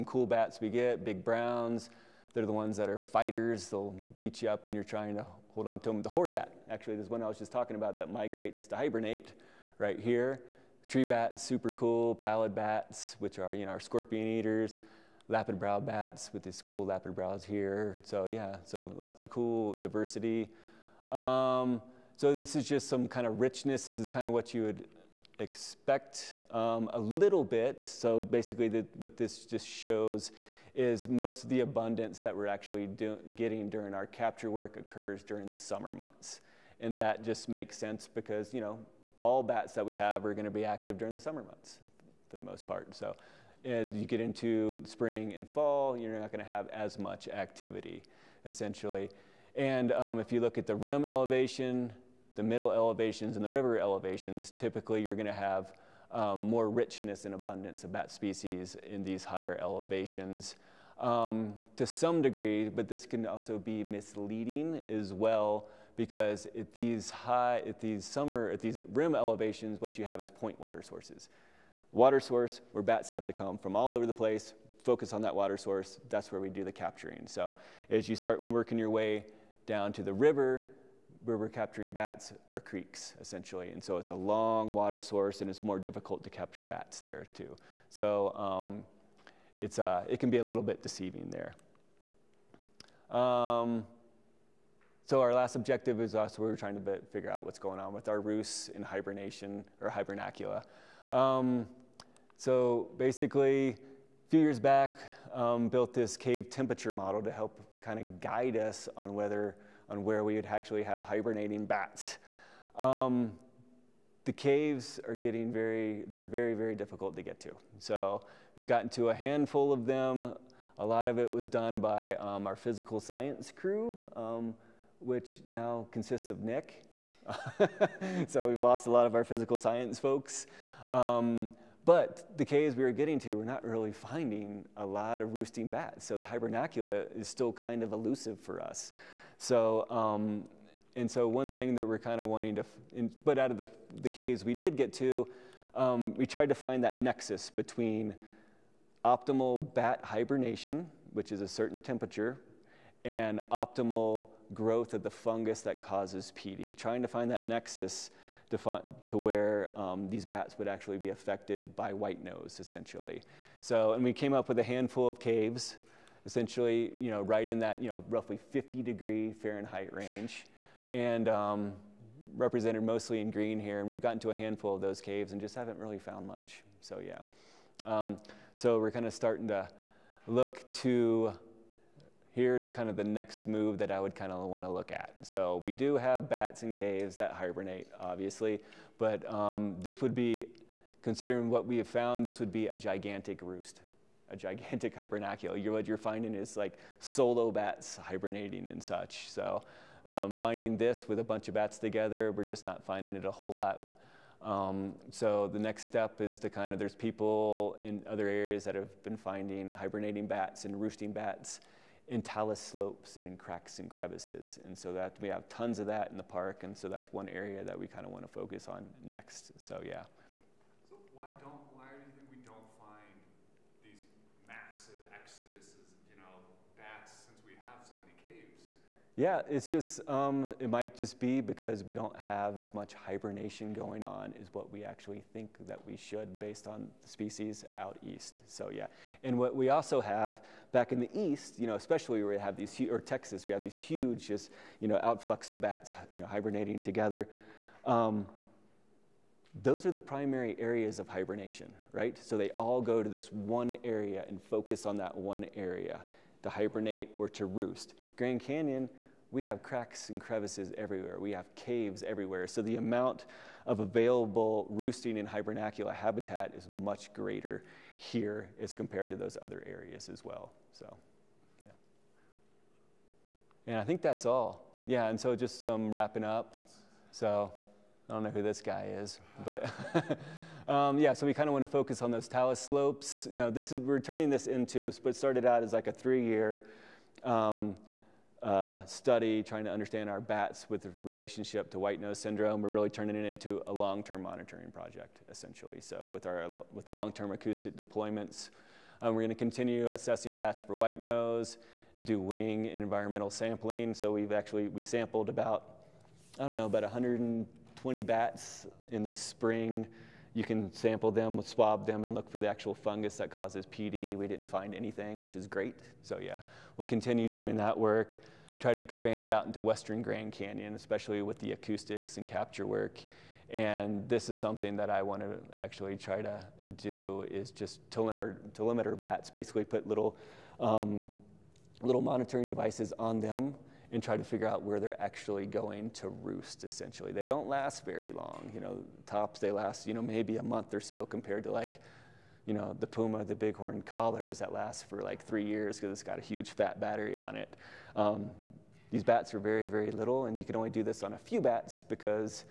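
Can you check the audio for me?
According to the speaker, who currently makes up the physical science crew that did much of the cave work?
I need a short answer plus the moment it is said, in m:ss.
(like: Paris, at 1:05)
Nick, at 2:06.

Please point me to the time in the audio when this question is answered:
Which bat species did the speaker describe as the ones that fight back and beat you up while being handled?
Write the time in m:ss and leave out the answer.
0:01.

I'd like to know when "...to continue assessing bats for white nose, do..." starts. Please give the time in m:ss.
4:59.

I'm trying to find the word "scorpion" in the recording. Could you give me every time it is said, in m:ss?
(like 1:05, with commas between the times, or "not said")
0:13.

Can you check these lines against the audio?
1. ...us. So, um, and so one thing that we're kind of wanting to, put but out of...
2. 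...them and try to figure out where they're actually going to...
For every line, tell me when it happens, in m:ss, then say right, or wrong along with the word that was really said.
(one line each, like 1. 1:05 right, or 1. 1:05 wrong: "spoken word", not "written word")
1. 2:18 right
2. 5:33 right.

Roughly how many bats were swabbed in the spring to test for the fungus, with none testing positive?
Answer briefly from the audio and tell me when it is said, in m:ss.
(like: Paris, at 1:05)
120, at 5:06.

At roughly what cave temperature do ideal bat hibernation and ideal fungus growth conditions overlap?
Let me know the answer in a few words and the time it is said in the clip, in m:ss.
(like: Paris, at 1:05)
50 degrees Fahrenheit, at 2:48.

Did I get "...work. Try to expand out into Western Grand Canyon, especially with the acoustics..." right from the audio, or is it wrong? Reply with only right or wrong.
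right.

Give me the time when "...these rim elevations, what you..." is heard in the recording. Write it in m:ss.
1:08.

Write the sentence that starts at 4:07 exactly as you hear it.
Um, those are the primary areas of hibernation, right?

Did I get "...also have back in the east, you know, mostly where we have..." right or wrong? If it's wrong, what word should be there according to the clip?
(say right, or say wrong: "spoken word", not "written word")
wrong: "especially", not "mostly".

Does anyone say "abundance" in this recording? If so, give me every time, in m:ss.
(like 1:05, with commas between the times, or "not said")
0:31, 0:57.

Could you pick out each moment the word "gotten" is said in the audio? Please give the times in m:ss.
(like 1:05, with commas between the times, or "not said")
1:58, 2:54.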